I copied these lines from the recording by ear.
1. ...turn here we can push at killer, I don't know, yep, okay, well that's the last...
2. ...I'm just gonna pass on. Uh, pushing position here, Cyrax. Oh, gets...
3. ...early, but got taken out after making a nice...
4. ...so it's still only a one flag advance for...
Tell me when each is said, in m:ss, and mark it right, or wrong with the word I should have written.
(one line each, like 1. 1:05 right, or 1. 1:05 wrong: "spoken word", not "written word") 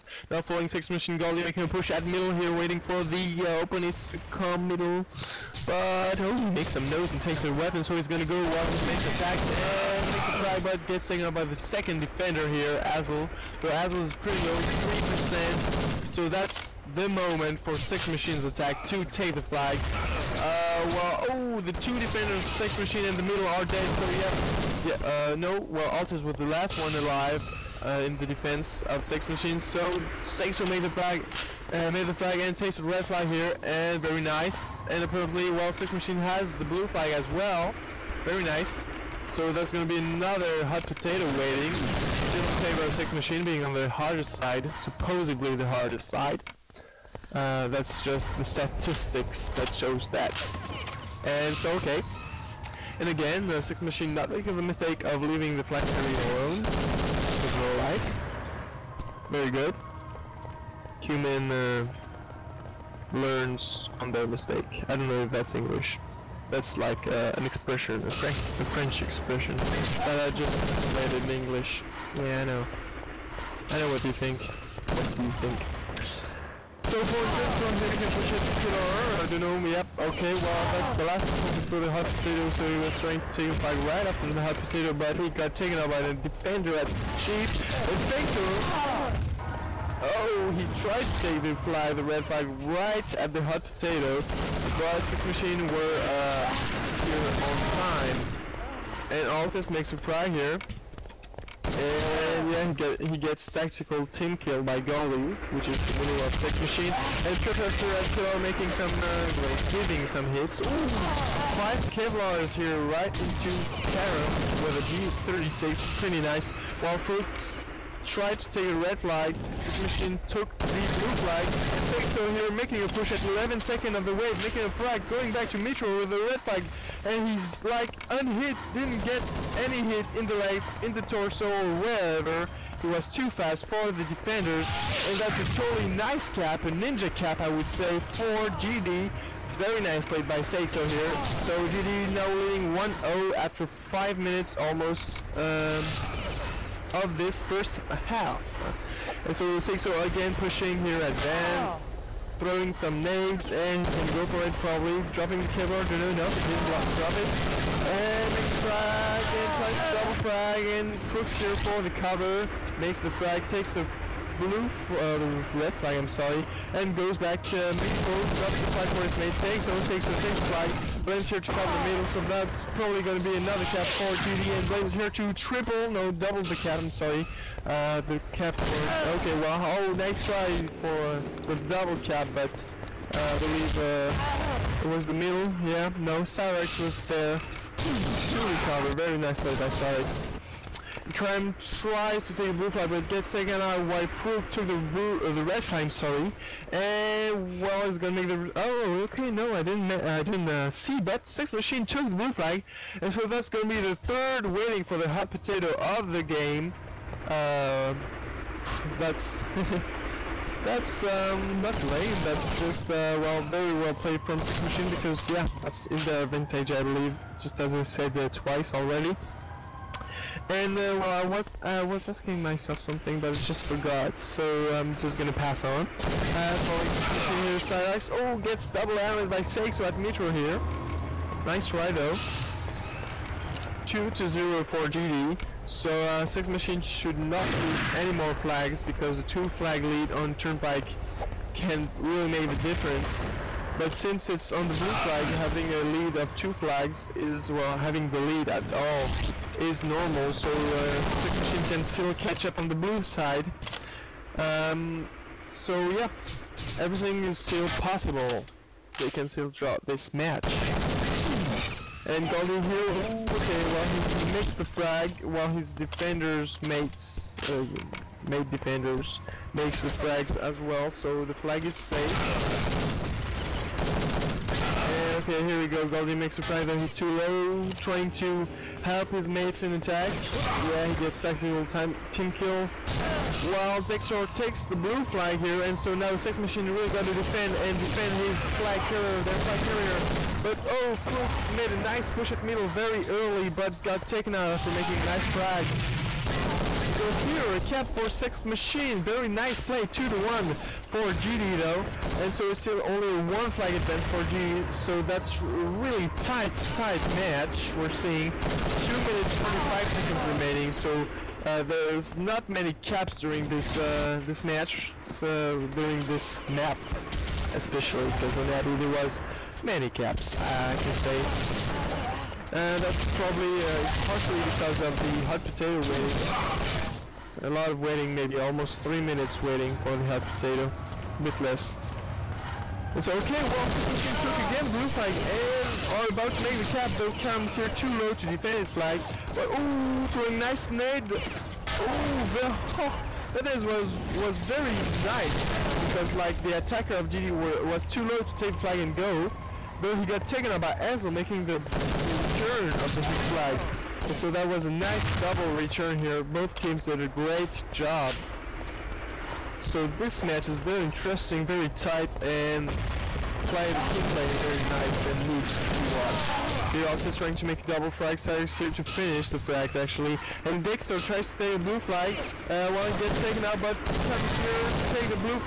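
1. 1:17 right
2. 3:44 wrong: "falling", not "pushing"
3. 4:53 right
4. 5:02 right.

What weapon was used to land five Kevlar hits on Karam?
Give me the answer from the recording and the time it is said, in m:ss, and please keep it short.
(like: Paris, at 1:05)
G36, at 1:54.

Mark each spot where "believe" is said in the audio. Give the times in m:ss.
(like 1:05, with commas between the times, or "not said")
3:03, 3:36.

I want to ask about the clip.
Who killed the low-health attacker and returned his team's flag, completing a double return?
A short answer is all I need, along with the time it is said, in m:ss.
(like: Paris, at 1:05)
Ansel, at 5:50.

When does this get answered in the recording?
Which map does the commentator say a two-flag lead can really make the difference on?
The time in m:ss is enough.
4:00.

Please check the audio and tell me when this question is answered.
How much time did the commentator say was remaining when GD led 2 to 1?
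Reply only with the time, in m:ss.
5:08.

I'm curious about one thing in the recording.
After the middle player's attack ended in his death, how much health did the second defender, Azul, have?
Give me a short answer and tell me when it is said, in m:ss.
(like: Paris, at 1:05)
3%, at 0:14.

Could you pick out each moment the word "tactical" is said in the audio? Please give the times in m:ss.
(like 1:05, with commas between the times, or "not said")
1:43, 4:41.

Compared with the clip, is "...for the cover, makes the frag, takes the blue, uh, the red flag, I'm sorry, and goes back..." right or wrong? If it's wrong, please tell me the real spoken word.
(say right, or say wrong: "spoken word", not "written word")
right.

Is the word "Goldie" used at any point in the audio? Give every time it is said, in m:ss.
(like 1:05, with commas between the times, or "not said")
0:01, 1:44, 4:22, 4:35.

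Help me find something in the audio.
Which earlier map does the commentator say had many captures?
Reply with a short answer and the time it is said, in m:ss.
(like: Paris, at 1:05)
Abbey, at 5:18.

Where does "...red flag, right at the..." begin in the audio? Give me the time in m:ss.
1:32.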